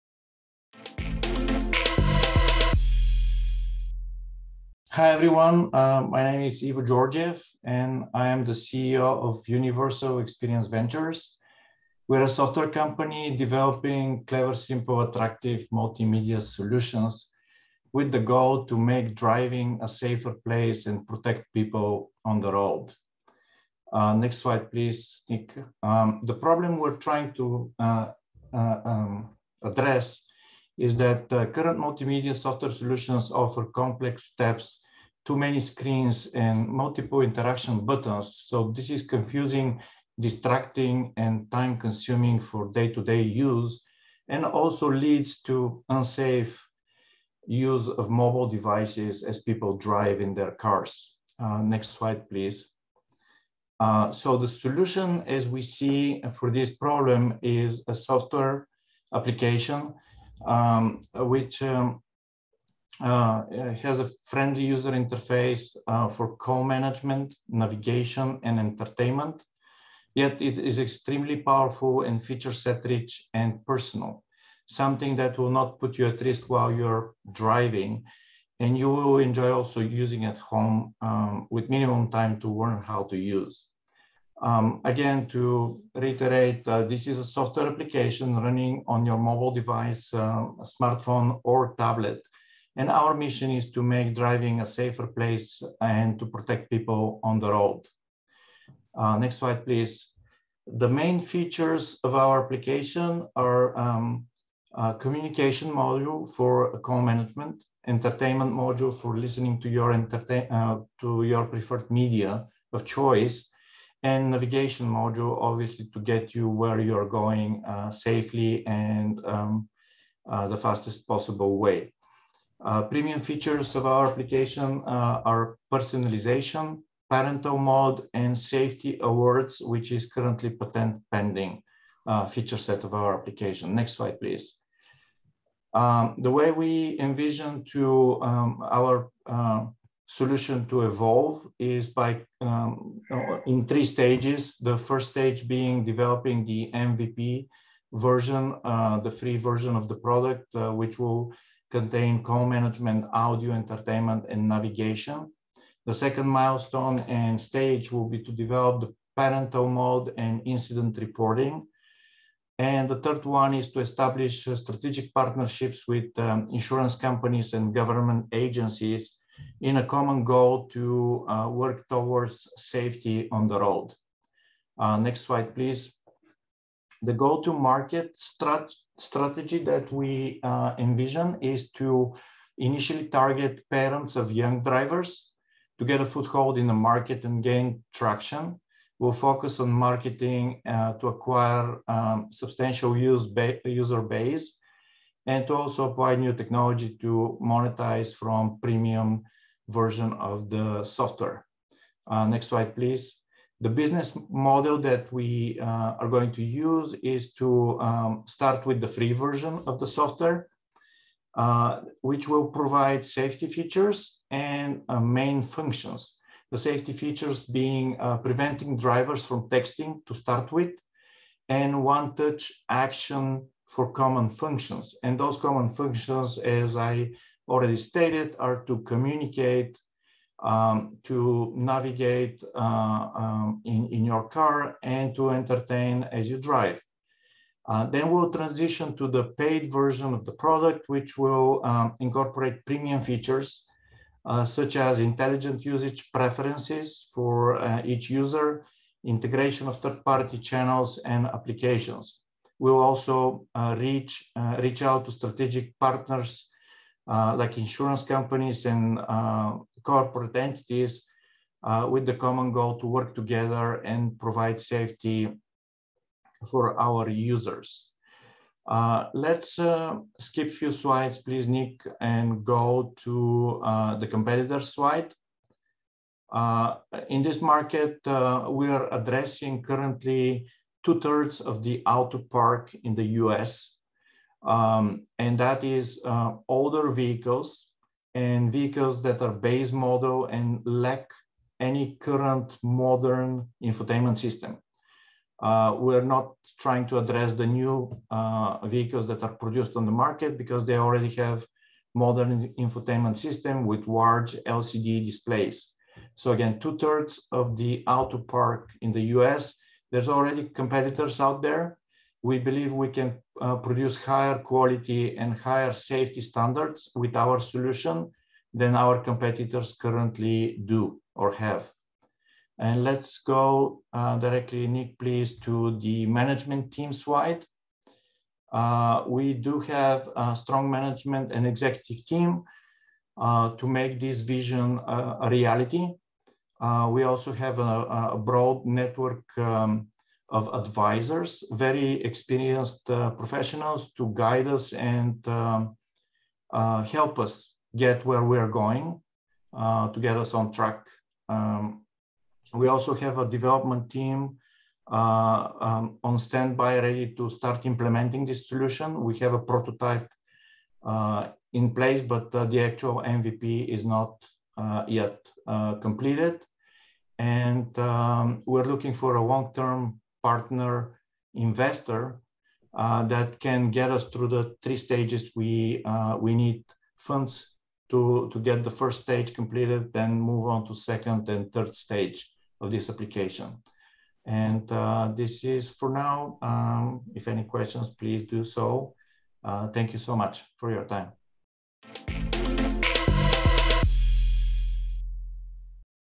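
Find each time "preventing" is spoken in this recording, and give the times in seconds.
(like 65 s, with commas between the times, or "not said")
218 s.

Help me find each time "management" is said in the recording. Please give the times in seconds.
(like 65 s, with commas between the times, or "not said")
66 s, 107 s, 152 s, 326 s, 330 s.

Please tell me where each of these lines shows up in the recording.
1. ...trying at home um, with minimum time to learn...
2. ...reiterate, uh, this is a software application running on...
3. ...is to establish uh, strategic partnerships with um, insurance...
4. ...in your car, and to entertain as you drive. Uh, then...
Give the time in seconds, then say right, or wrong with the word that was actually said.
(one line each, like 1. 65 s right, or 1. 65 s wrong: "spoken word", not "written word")
1. 79 s wrong: "using", not "trying"
2. 85 s right
3. 163 s right
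4. 233 s right.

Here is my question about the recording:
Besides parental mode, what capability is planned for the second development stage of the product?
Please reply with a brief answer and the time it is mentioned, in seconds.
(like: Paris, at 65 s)
Incident reporting, at 160 s.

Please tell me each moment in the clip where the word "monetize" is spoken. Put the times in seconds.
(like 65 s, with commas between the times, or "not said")
197 s.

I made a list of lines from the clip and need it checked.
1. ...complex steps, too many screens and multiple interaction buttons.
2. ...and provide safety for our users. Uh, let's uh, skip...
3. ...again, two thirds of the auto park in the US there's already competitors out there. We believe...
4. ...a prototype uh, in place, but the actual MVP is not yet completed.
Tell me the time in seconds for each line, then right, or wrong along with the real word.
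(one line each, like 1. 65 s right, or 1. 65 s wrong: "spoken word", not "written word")
1. 33 s right
2. 263 s right
3. 306 s right
4. 359 s right.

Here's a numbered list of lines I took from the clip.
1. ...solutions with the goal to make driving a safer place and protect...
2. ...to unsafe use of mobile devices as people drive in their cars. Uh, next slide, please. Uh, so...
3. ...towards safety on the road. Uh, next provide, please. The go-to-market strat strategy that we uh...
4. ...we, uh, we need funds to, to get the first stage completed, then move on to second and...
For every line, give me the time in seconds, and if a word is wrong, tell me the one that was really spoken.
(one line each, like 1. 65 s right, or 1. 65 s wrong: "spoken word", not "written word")
1. 16 s right
2. 45 s right
3. 171 s wrong: "slide", not "provide"
4. 375 s right.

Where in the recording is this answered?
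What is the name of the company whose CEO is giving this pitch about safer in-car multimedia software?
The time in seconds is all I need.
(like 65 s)
9 s.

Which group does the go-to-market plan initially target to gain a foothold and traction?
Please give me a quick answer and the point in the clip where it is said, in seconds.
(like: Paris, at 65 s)
Parents of young drivers, at 183 s.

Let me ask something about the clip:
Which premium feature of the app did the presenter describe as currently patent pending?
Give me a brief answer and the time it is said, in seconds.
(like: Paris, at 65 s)
Safety alerts, at 128 s.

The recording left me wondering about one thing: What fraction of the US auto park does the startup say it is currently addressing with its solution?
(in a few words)
Two-thirds.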